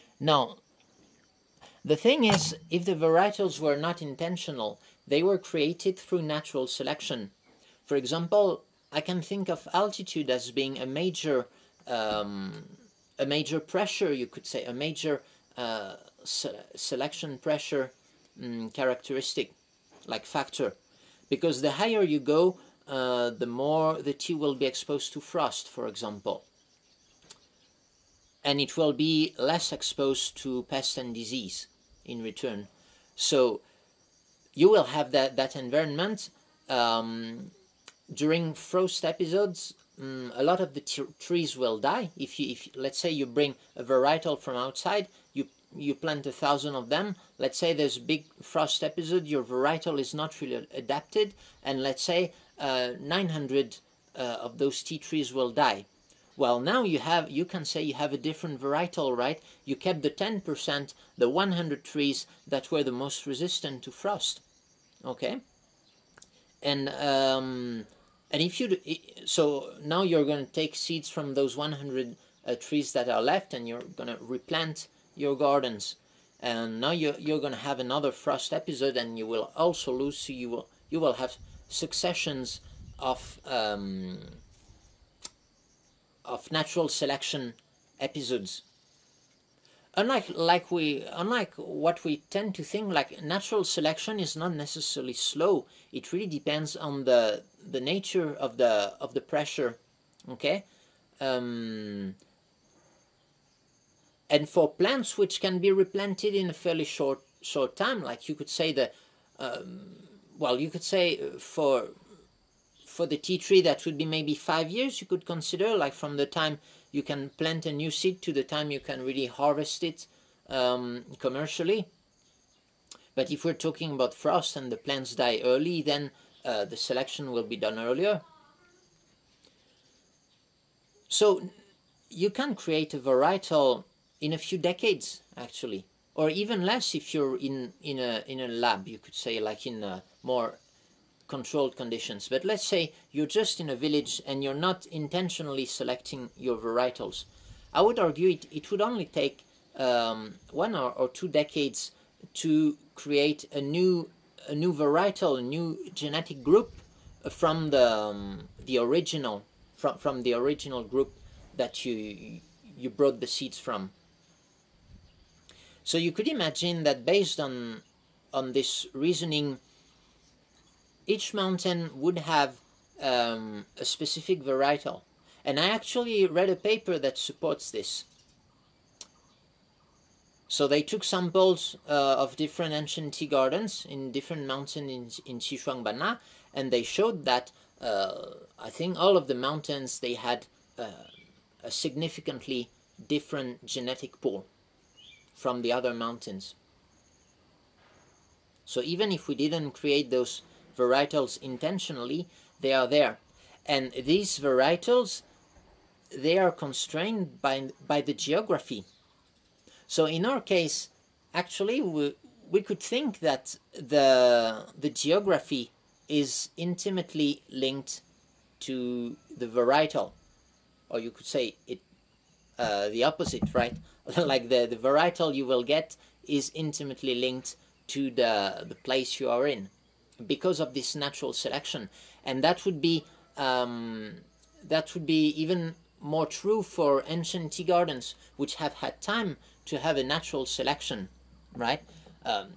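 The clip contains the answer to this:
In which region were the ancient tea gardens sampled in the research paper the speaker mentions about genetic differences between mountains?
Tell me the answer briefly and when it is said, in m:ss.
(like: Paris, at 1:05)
Sichuan, at 3:05.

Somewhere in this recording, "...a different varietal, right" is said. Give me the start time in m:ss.
0:58.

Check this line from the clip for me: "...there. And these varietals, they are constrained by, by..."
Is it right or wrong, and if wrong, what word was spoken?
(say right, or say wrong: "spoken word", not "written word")
right.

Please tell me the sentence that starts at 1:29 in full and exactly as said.
Unlike, like we, unlike what we tend to think, like natural selection is not necessarily slow.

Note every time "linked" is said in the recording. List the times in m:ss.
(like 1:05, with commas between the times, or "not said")
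3:37, 3:47.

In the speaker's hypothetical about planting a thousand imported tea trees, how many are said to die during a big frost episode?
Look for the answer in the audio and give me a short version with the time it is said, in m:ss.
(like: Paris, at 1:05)
900, at 0:52.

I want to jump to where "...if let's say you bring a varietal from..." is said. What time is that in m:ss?
0:42.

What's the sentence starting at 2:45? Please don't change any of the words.
So you could imagine that based on on this reasoning, each mountain would have um, a specific varietal.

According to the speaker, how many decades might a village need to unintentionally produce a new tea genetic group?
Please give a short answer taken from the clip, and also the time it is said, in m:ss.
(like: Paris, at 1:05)
1 or 2 decades, at 2:30.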